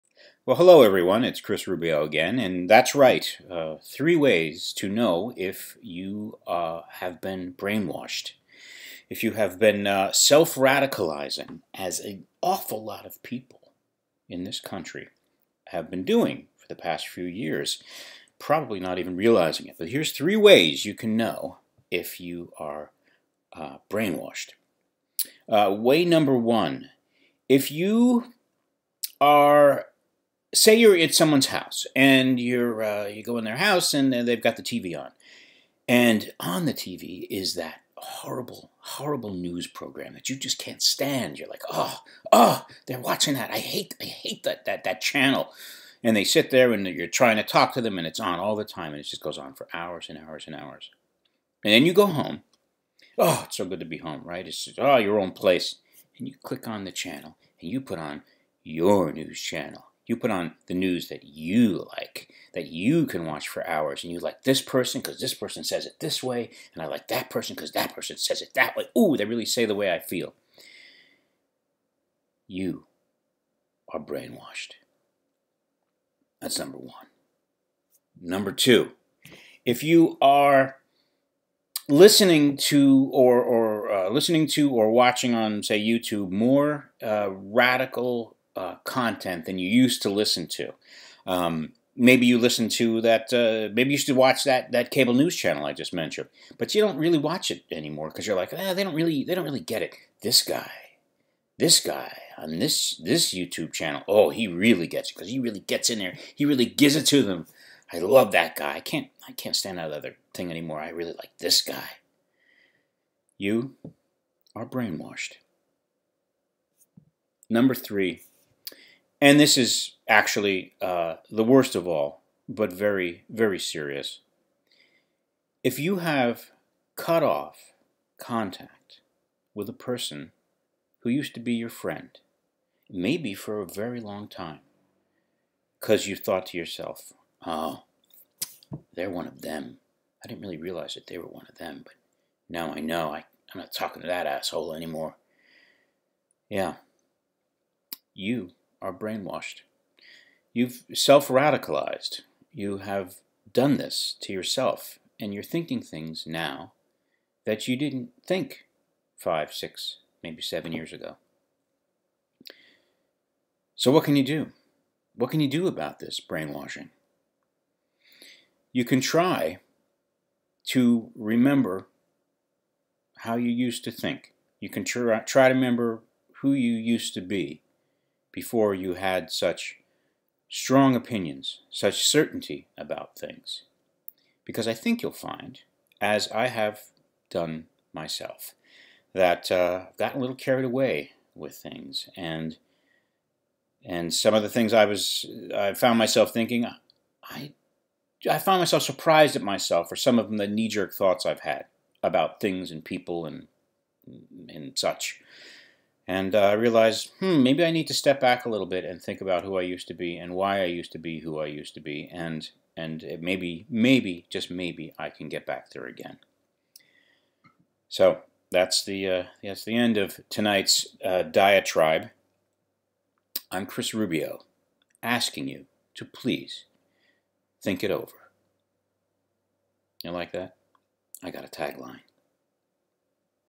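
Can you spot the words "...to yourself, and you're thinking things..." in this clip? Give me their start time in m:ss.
2:34.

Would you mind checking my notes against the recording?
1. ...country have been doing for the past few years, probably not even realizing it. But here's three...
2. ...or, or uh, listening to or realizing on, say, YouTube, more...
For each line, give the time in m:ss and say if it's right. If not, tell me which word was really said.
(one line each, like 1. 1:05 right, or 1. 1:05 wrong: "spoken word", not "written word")
1. 0:14 right
2. 1:23 wrong: "watching", not "realizing".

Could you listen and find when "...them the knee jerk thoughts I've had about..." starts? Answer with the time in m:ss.
3:20.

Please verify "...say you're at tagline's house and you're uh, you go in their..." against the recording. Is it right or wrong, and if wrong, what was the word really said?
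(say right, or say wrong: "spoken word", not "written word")
wrong: "someone", not "tagline".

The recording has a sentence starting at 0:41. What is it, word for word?
You're like, oh, oh, they're watching that.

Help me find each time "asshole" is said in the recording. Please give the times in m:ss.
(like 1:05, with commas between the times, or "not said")
2:24.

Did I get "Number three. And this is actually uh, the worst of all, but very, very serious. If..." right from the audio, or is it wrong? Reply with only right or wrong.
right.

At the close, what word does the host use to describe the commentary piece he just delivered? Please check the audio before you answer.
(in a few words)
diatribe.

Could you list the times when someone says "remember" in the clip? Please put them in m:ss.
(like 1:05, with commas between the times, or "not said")
2:51, 2:55.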